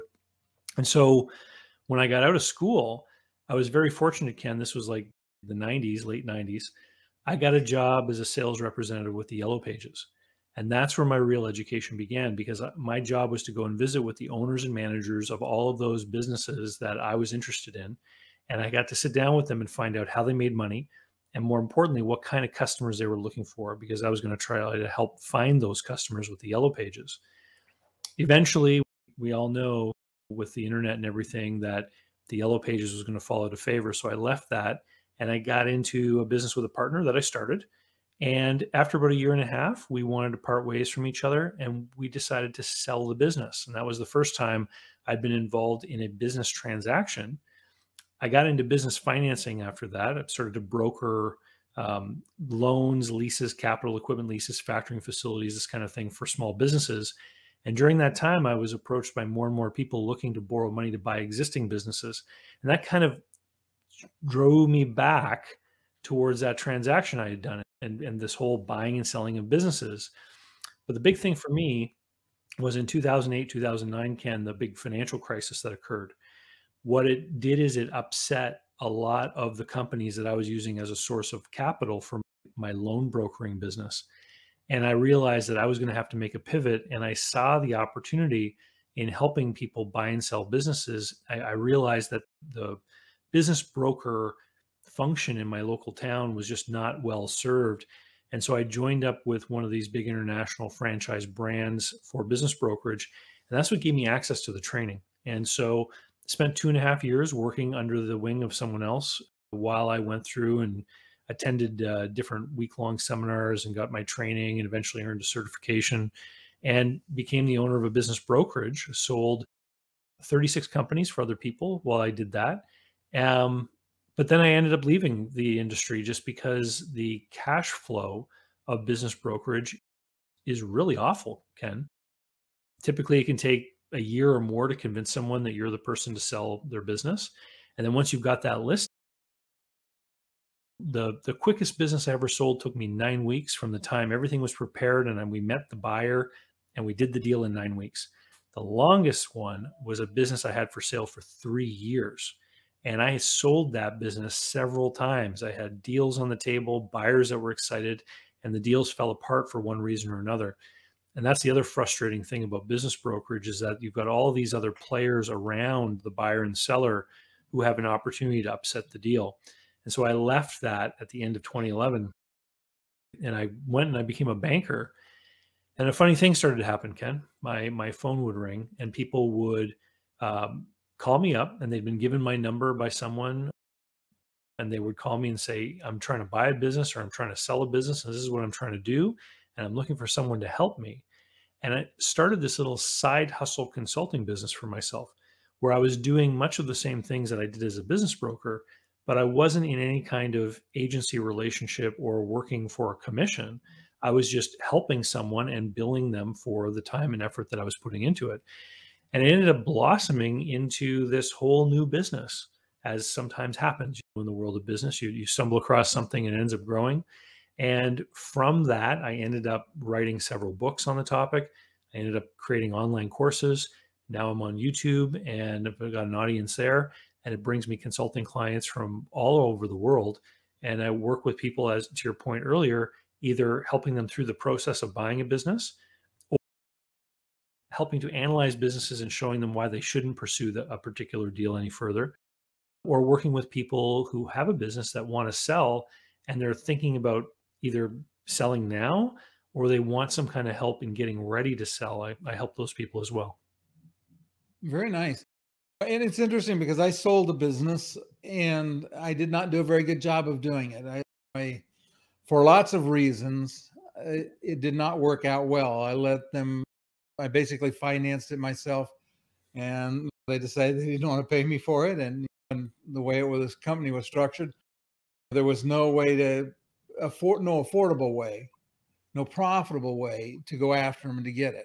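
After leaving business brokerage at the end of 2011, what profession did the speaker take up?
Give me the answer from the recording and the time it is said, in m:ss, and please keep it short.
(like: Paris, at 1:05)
banker, at 2:54.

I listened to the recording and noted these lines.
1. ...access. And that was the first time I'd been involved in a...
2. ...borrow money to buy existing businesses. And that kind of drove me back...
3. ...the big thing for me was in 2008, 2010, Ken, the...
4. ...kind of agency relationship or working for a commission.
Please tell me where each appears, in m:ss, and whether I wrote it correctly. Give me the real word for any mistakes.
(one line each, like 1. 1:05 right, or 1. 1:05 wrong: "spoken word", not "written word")
1. 0:43 wrong: "business", not "access"
2. 1:00 right
3. 1:10 wrong: "2009", not "2010"
4. 3:20 right.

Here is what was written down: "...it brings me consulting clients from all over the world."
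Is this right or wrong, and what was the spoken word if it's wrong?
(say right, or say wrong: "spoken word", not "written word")
right.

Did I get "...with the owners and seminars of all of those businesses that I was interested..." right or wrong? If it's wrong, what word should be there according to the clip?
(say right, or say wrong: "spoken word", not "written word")
wrong: "managers", not "seminars".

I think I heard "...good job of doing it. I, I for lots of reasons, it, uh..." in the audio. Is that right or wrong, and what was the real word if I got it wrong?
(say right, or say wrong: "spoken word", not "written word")
right.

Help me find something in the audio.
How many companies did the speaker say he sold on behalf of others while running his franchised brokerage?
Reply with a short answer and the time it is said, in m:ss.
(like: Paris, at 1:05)
36, at 2:00.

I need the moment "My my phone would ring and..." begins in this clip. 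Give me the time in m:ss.
2:57.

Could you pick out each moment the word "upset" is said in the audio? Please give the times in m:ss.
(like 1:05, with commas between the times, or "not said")
1:17, 2:48.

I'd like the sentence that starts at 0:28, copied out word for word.
Eventually, we all know with the internet and everything that the Yellow Pages was going to fall out of favor.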